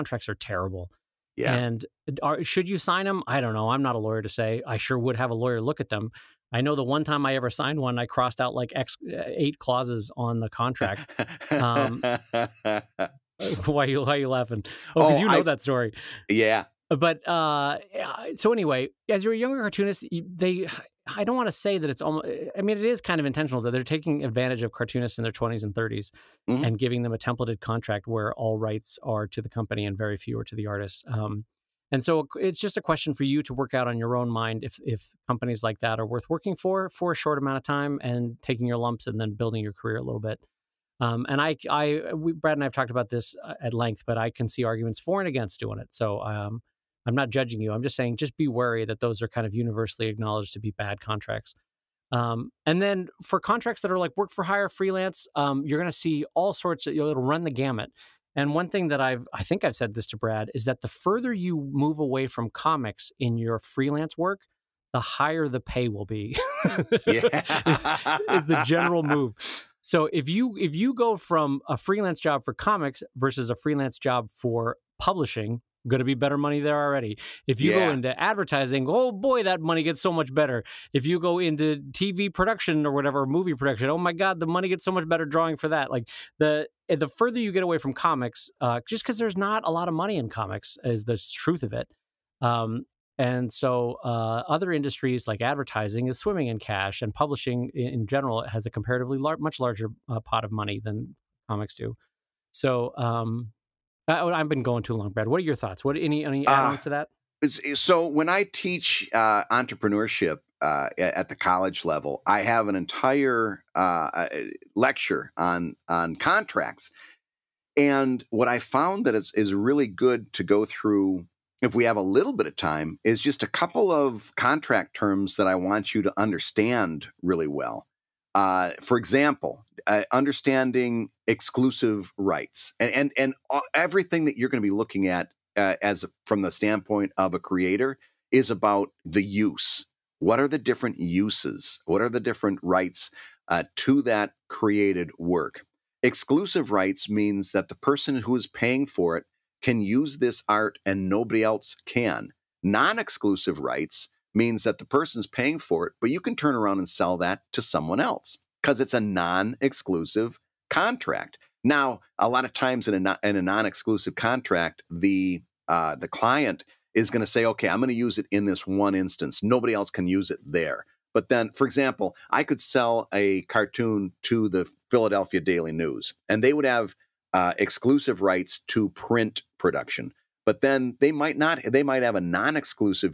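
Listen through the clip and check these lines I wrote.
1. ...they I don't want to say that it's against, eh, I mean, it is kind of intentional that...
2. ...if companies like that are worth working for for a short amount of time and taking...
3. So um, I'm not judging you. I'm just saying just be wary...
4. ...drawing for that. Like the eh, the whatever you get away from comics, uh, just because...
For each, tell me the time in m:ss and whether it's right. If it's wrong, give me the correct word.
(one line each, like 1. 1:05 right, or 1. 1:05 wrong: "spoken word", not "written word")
1. 0:20 wrong: "almost", not "against"
2. 0:34 right
3. 0:45 right
4. 1:25 wrong: "further", not "whatever".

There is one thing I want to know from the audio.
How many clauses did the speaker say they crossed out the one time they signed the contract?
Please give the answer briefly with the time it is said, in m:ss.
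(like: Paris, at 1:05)
8, at 0:09.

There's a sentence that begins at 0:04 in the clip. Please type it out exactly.
I sure would have a lawyer look at them.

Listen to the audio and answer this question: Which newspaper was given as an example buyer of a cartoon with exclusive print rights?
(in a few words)
Philadelphia Daily News.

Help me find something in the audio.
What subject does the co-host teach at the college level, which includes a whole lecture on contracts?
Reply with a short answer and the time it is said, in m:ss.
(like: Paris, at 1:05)
entrepreneurship, at 1:49.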